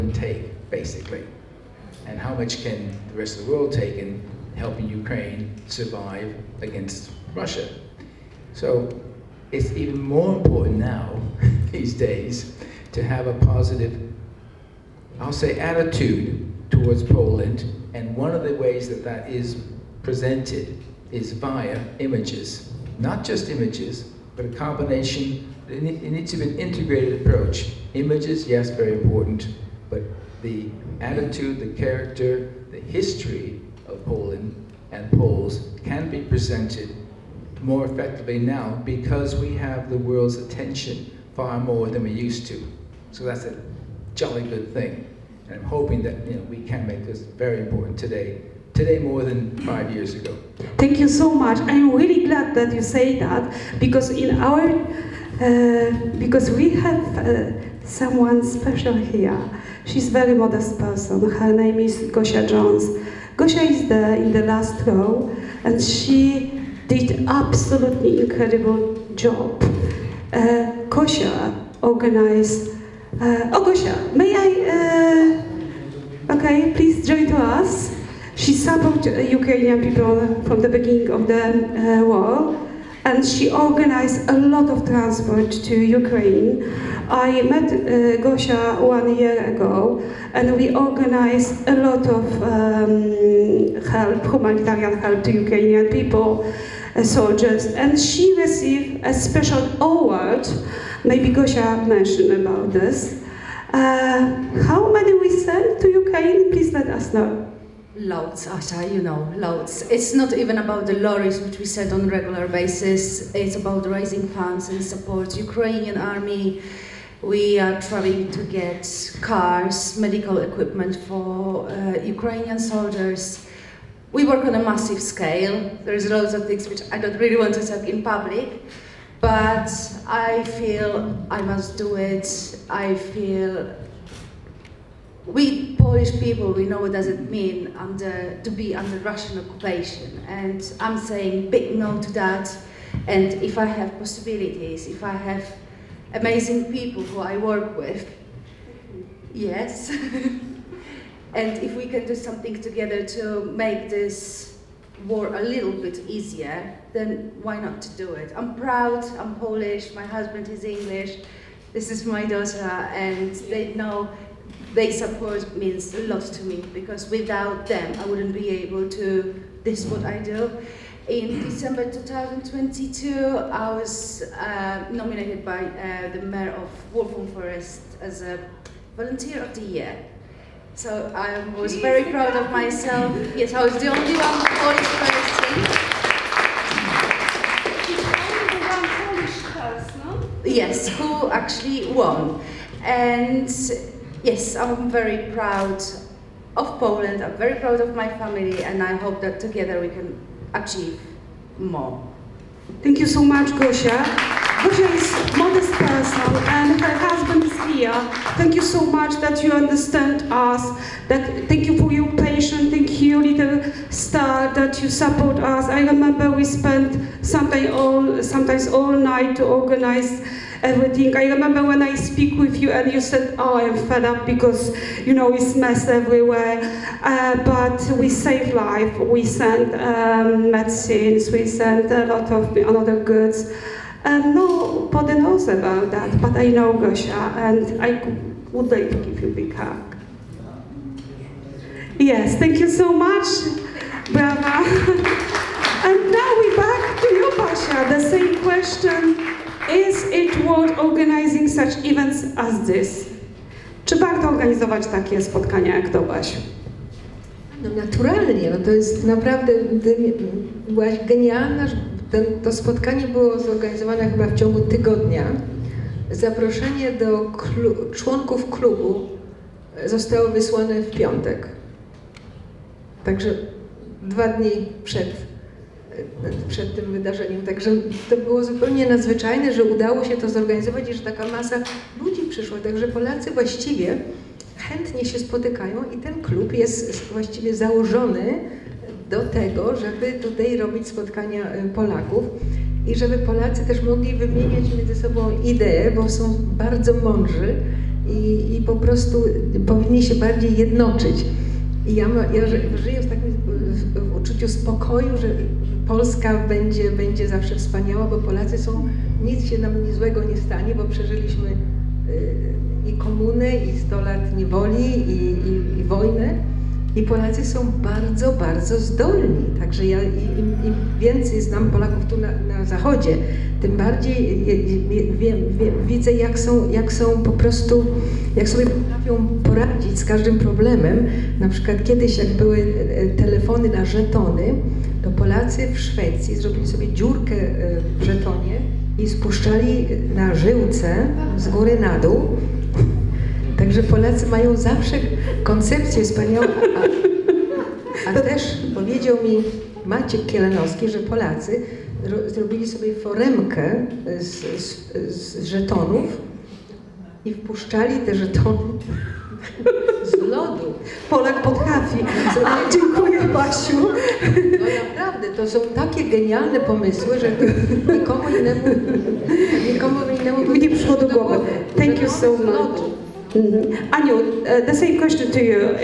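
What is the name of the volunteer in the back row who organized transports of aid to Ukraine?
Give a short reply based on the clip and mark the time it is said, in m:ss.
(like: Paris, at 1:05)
Gosia Jones, at 1:02.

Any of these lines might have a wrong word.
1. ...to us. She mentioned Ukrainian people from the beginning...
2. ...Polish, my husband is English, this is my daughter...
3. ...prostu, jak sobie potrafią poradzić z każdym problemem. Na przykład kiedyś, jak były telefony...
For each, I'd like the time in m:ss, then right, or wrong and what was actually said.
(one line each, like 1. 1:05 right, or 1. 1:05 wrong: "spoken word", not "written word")
1. 1:17 wrong: "supported", not "mentioned"
2. 2:39 right
3. 5:27 right.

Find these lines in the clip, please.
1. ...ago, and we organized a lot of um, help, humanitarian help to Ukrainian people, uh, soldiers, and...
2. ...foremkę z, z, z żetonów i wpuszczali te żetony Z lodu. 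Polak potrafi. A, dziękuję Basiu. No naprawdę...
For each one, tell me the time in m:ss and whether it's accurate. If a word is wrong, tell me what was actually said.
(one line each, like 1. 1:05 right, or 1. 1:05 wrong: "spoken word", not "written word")
1. 1:29 right
2. 5:52 right.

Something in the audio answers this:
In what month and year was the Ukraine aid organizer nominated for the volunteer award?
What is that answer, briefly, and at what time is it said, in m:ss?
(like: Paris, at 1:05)
December 2022, at 2:51.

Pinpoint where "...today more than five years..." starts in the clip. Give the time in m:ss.
0:48.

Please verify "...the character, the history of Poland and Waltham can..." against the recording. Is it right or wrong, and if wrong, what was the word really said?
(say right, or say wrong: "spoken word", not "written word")
wrong: "Poles", not "Waltham".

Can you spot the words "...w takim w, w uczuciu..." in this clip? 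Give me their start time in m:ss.
5:03.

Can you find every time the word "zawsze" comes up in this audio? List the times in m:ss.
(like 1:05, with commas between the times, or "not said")
5:07, 5:44.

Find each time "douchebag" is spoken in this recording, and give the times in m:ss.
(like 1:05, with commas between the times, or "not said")
not said.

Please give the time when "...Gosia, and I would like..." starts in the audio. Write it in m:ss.
3:56.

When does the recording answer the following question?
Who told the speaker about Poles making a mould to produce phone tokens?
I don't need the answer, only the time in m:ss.
5:49.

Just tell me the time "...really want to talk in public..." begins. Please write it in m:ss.
2:07.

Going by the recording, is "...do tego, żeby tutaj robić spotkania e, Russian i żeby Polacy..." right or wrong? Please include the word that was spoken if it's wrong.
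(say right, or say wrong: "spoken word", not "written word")
wrong: "Polaków", not "Russian".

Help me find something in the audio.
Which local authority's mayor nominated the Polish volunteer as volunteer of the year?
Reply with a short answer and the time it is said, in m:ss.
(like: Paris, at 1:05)
Waltham Forest, at 2:56.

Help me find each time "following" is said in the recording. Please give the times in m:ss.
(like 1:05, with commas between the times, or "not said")
not said.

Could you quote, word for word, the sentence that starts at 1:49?
It's not even about the lorries, which we said on a regular basis.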